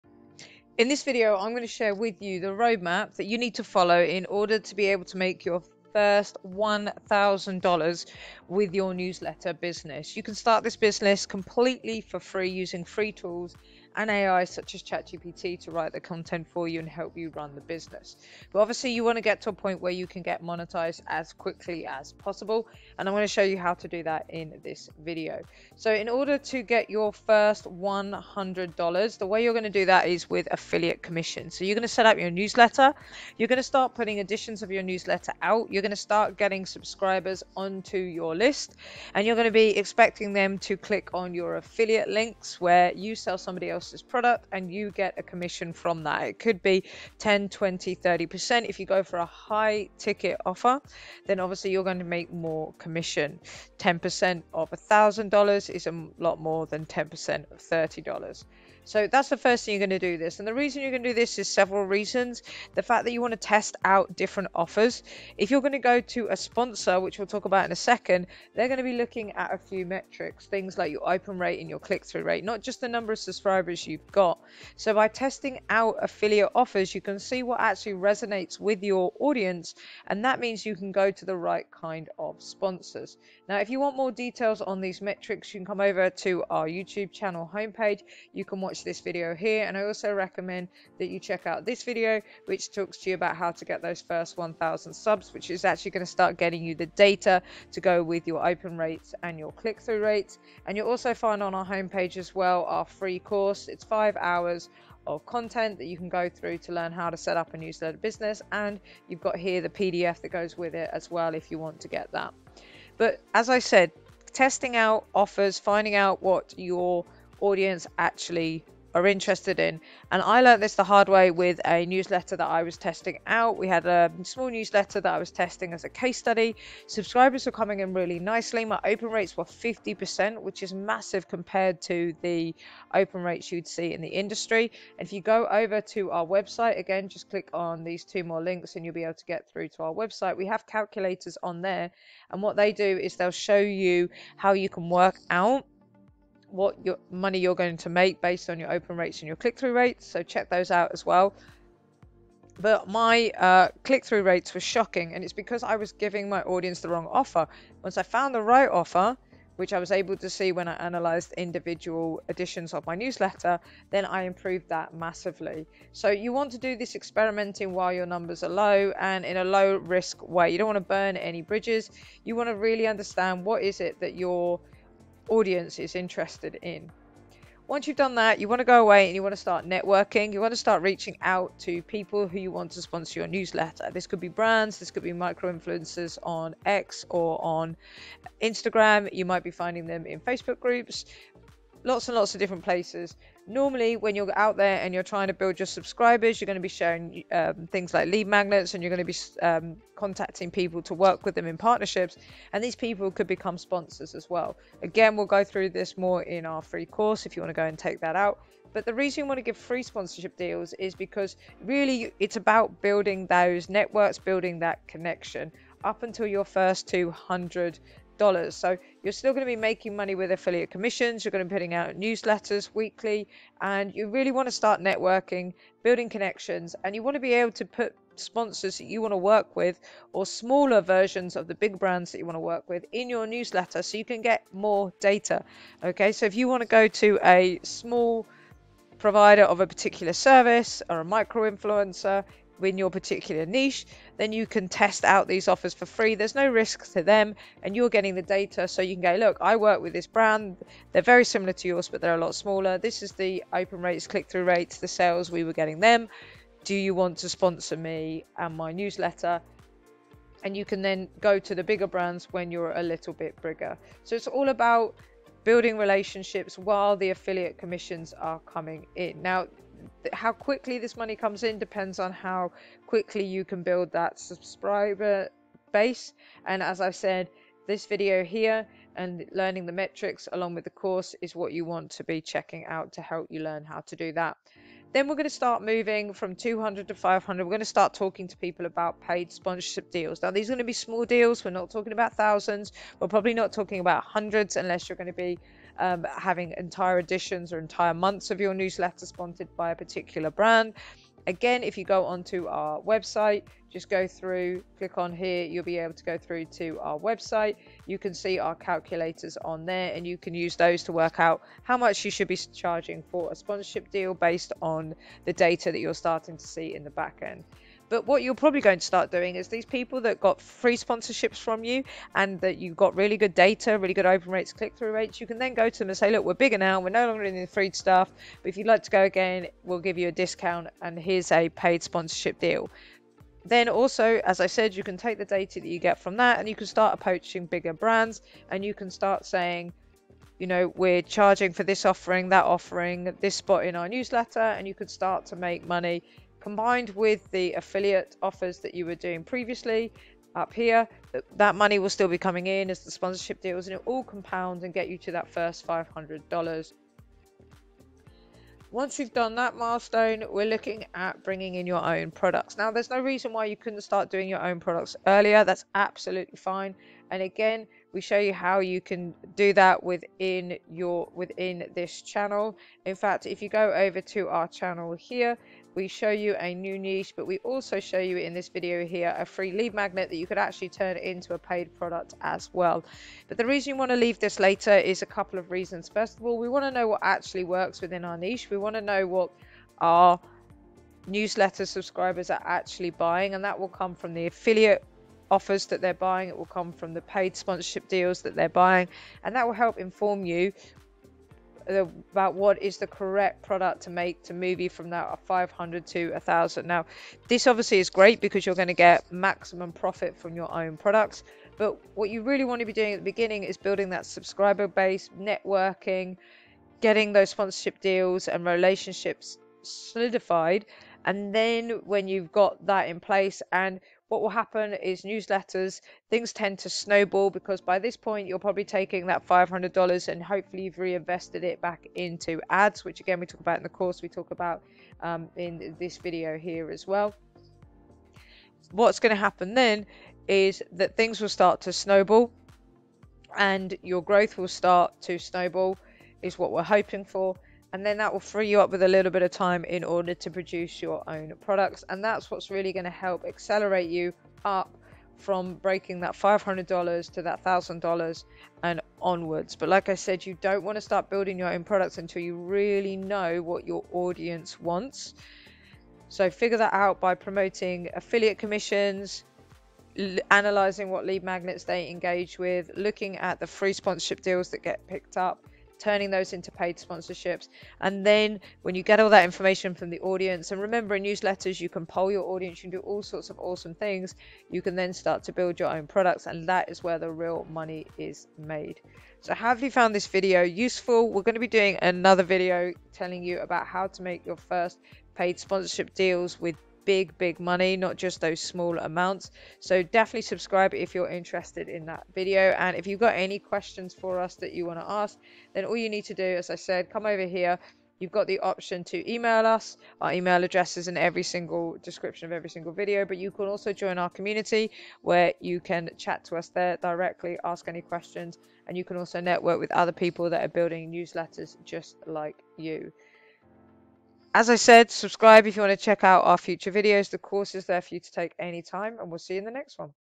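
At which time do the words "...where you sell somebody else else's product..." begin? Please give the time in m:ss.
0:42.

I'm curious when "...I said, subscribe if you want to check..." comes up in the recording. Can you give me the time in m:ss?
8:44.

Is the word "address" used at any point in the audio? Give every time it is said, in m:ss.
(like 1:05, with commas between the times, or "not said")
8:30.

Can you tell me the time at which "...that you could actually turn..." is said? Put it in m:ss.
6:20.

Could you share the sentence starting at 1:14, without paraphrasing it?
So by testing out affiliate offers, you can see what actually resonates with your audience.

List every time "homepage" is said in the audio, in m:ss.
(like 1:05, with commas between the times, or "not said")
1:27, 1:41.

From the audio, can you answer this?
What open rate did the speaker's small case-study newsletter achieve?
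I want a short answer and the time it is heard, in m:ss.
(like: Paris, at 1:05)
50%, at 2:09.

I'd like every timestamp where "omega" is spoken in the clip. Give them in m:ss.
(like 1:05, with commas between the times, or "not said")
not said.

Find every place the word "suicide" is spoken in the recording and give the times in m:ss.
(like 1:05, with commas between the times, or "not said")
not said.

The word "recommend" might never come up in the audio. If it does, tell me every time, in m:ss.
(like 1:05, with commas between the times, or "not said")
1:30.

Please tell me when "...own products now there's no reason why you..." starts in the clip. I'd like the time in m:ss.
6:01.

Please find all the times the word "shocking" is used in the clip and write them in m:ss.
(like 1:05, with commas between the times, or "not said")
2:34.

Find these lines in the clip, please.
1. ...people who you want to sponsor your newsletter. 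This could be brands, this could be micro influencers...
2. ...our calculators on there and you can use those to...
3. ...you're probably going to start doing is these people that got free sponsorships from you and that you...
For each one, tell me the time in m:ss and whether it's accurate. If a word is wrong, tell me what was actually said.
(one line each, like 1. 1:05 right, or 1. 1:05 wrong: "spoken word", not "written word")
1. 3:01 right
2. 5:08 right
3. 5:18 right.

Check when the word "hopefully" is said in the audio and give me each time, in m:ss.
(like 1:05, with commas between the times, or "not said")
7:10.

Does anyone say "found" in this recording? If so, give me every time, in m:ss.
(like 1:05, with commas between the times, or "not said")
2:38, 8:09.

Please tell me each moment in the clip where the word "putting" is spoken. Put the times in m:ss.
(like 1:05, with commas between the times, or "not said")
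0:33, 3:41.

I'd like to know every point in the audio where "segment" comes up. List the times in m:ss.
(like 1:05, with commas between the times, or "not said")
not said.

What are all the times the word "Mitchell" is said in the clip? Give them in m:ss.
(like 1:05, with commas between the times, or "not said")
not said.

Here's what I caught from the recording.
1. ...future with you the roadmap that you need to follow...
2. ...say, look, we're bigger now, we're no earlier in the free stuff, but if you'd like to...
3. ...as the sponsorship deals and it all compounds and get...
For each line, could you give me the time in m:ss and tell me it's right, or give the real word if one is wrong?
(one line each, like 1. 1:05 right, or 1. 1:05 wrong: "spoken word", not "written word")
1. 0:01 wrong: "share", not "future"
2. 5:25 wrong: "longer", not "earlier"
3. 5:52 right.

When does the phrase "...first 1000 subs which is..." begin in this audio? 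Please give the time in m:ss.
1:34.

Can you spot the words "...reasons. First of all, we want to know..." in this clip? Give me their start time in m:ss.
6:25.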